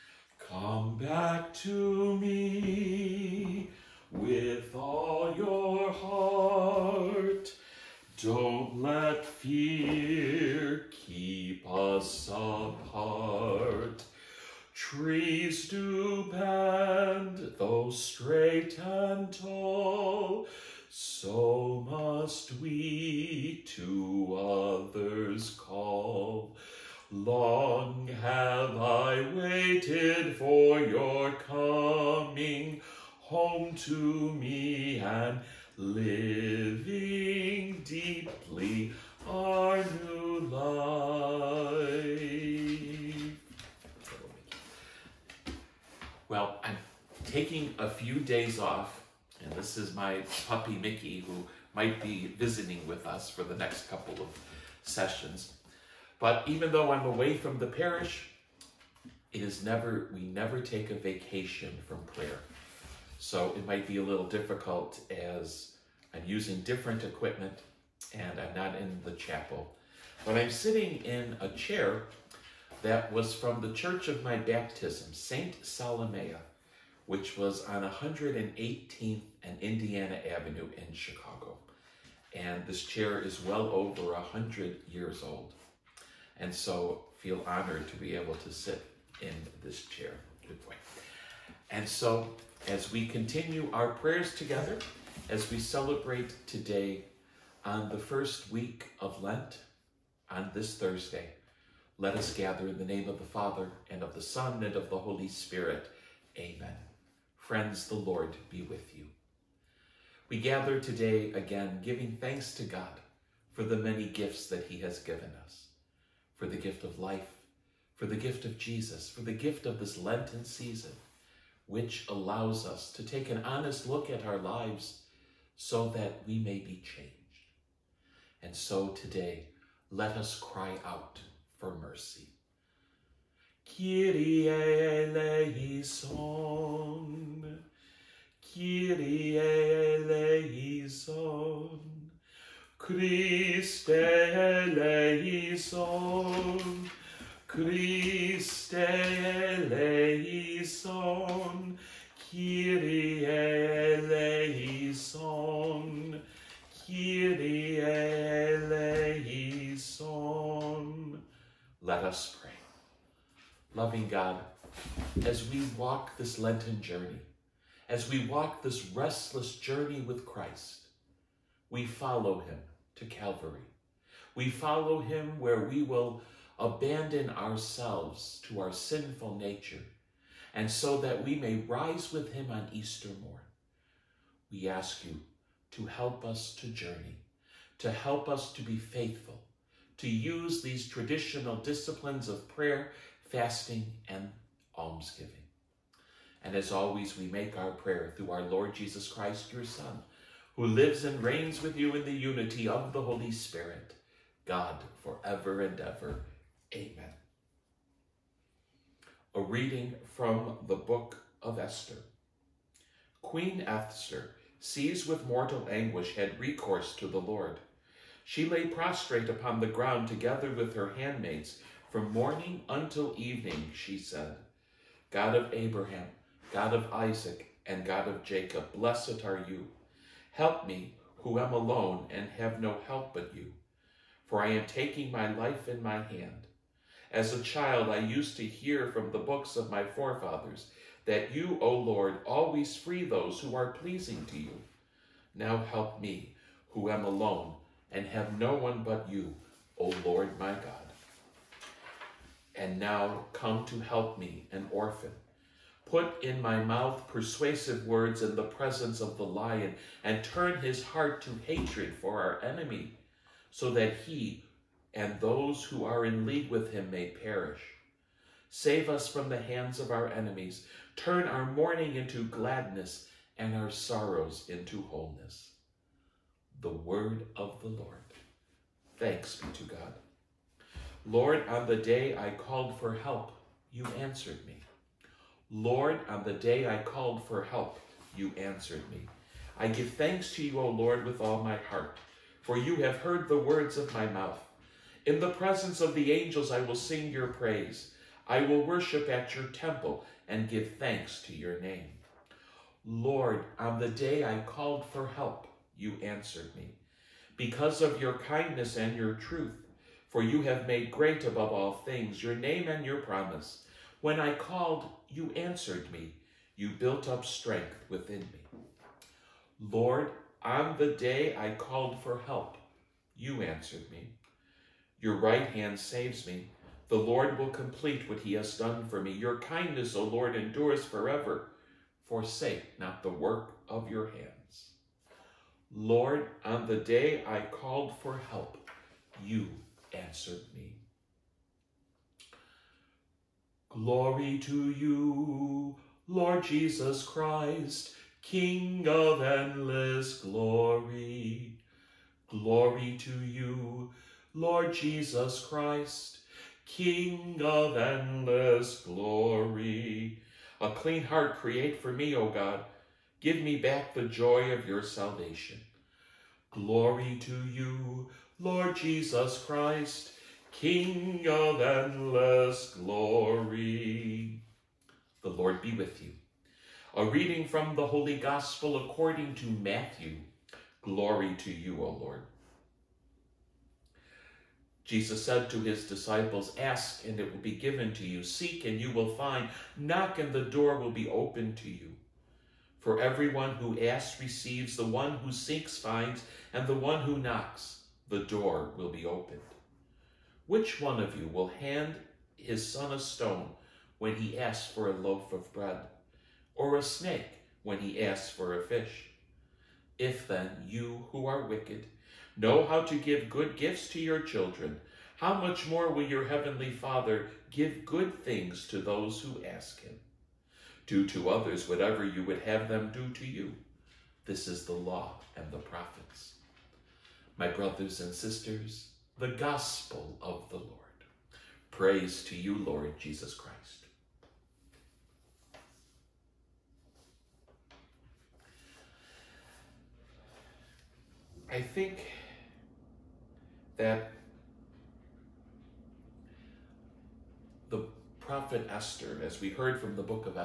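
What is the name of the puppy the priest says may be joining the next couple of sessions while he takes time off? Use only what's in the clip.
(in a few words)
Mickey.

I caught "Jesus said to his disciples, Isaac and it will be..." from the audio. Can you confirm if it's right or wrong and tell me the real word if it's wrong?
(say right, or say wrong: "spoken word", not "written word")
wrong: "Ask", not "Isaac".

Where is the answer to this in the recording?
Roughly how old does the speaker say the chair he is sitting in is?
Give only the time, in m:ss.
1:23.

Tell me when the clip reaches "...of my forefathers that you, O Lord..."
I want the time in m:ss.
3:59.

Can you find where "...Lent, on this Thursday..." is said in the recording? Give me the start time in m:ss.
1:39.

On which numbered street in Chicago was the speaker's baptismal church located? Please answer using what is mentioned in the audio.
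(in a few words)
118th.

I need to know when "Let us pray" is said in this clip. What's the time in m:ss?
2:41.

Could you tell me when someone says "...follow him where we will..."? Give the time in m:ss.
2:54.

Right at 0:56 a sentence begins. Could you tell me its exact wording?
But even though I'm away from the parish, it is never, we never take a vacation from prayer.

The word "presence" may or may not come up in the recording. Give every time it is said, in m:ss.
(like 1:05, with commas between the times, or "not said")
4:18, 4:55.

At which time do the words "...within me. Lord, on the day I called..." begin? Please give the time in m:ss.
5:17.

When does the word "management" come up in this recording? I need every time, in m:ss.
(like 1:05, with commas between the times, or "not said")
not said.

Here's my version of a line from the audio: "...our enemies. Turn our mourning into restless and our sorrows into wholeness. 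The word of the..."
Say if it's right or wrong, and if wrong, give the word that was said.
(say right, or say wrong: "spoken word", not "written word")
wrong: "gladness", not "restless".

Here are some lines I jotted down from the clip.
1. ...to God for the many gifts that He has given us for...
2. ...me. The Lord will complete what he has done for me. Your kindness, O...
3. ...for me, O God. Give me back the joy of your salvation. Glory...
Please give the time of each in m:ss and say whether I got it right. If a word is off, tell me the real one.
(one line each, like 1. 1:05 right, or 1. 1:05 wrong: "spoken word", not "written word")
1. 1:52 right
2. 5:26 right
3. 6:01 right.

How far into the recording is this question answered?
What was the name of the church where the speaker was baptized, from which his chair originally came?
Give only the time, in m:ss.
1:15.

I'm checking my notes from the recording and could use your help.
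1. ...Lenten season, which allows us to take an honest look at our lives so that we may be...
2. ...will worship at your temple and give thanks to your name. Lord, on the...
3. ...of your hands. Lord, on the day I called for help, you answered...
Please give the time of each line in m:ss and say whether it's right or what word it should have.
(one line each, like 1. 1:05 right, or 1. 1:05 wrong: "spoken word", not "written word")
1. 1:59 right
2. 4:58 right
3. 5:33 right.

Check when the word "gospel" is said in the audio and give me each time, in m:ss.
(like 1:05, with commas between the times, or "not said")
6:18, 7:09.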